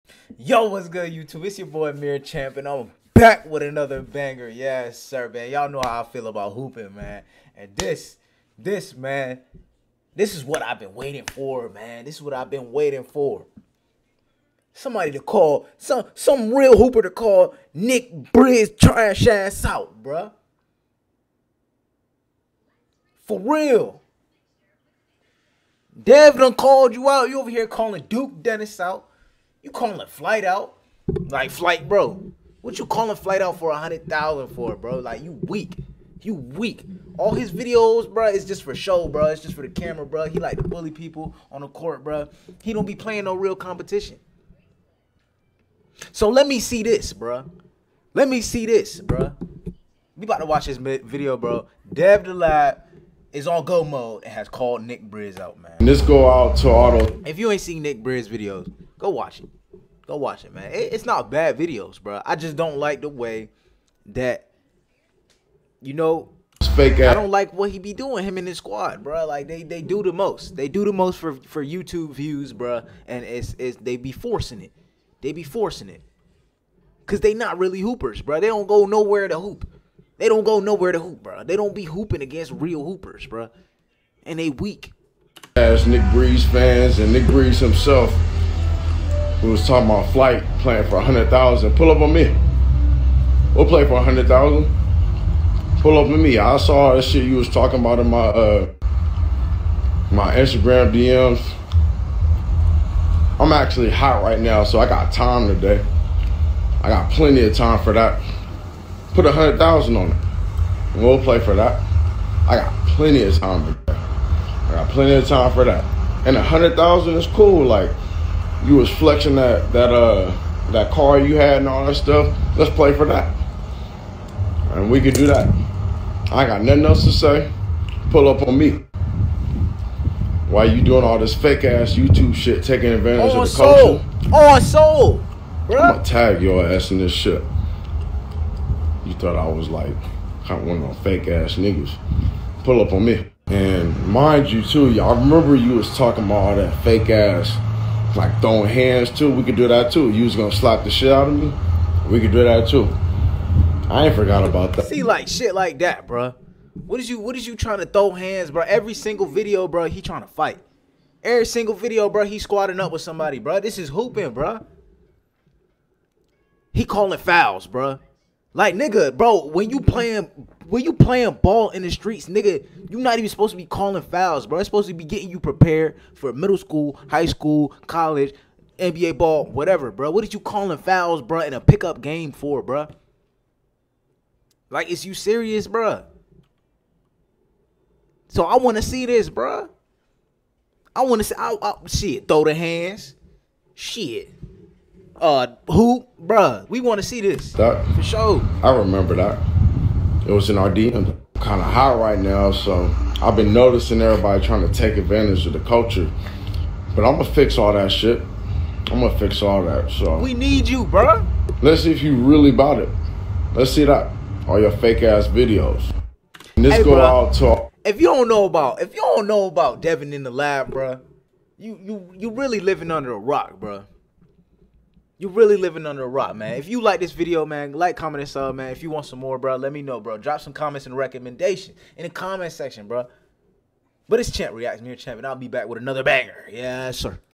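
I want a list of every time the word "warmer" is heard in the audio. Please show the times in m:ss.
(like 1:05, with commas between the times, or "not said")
not said.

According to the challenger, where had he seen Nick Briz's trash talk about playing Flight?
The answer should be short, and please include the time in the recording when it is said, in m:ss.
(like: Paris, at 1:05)
Instagram DMs, at 1:40.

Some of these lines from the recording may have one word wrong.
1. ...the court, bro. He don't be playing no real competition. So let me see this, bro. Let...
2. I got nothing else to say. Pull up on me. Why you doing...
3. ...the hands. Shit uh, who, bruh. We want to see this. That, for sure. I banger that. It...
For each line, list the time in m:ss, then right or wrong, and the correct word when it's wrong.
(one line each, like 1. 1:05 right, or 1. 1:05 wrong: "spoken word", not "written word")
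1. 0:41 right
2. 2:06 right
3. 3:12 wrong: "remember", not "banger".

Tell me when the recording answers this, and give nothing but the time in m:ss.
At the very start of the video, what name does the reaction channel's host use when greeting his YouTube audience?
0:01.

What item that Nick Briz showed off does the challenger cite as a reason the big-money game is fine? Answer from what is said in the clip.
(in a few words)
Car.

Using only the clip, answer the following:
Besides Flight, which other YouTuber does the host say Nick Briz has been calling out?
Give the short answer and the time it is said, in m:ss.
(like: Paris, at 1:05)
Duke Dennis, at 0:28.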